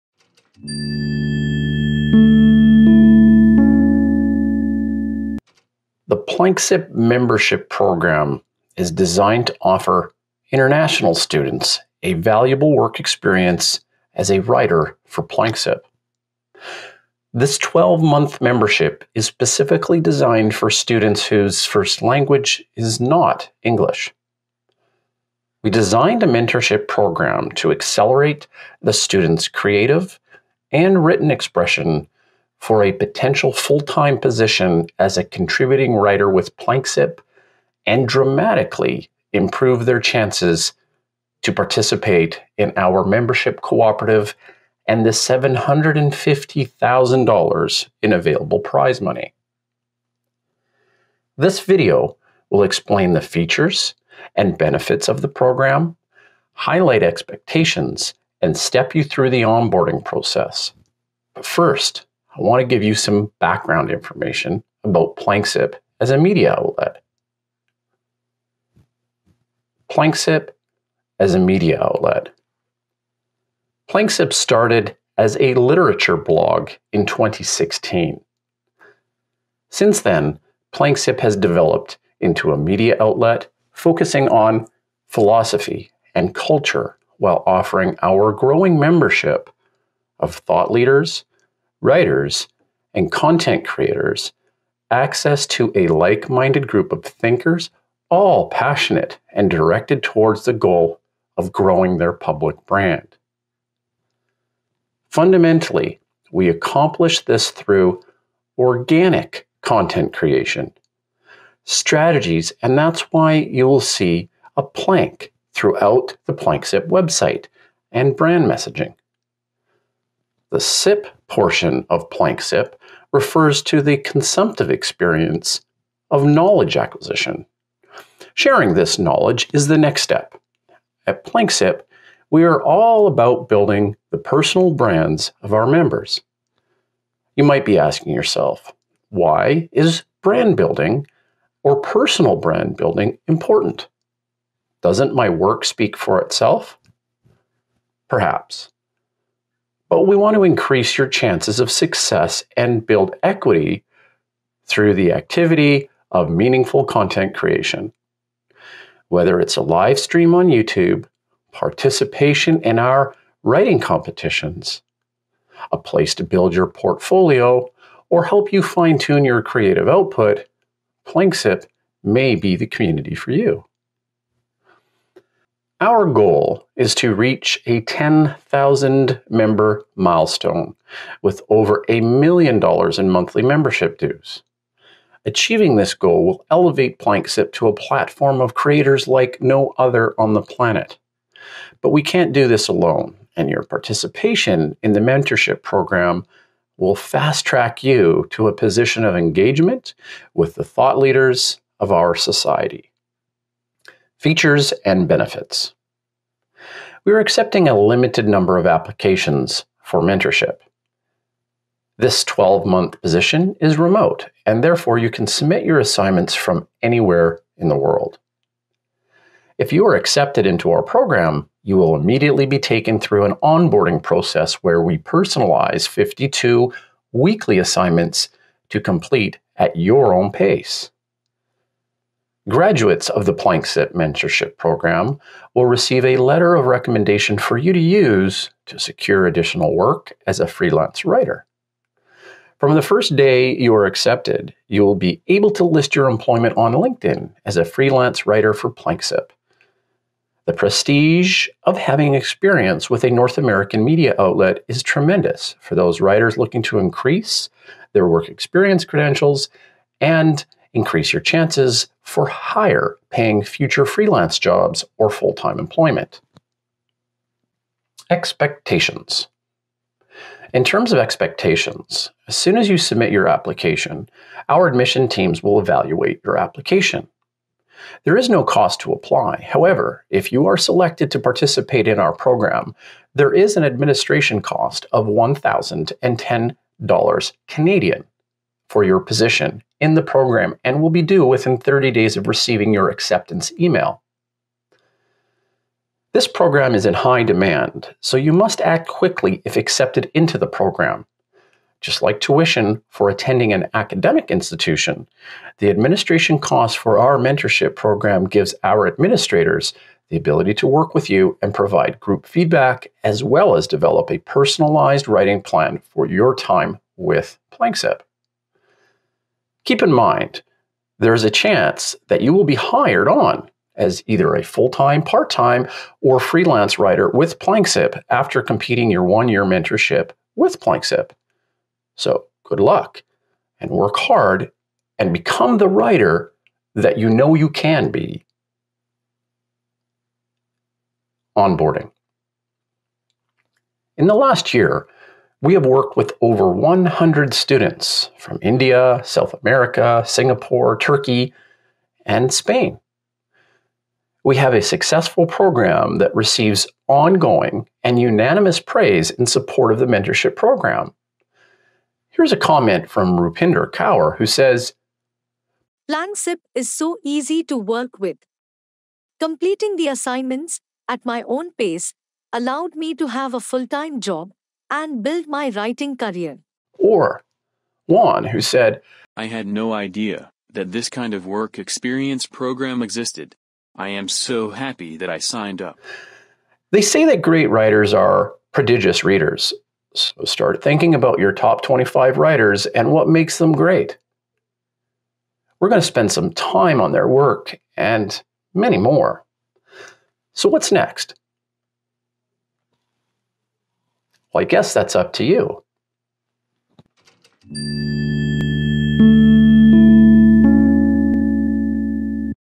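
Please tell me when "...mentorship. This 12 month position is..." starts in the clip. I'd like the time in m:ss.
3:29.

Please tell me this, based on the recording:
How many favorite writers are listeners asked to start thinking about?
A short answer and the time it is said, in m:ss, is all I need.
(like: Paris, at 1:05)
25, at 6:31.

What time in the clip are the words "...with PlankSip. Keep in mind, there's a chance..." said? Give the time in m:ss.
5:16.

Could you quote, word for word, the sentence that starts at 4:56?
This program is in high demand, so you must act quickly if accepted into the program.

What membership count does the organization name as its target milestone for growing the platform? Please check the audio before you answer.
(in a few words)
10,000.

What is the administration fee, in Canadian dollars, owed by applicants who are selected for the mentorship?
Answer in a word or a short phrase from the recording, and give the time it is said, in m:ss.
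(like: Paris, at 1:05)
$1,010, at 4:45.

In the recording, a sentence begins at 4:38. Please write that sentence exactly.
There is no cost to apply.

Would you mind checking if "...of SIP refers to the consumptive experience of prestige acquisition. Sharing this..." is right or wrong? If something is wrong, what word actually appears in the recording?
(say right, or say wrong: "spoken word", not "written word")
wrong: "knowledge", not "prestige".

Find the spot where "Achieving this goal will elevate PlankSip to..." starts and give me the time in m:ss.
3:05.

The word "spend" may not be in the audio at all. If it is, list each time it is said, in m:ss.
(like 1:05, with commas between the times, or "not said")
6:35.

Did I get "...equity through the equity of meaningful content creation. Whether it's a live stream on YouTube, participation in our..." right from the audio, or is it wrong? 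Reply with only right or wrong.
wrong.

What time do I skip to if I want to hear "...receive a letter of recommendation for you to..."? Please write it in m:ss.
3:55.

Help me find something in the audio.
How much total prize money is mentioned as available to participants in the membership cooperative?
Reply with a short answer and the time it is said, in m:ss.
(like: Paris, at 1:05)
$750,000, at 0:45.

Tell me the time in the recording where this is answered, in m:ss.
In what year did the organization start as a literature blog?
1:17.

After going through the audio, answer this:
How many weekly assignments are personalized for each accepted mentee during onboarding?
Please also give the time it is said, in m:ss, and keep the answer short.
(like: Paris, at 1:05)
52, at 3:45.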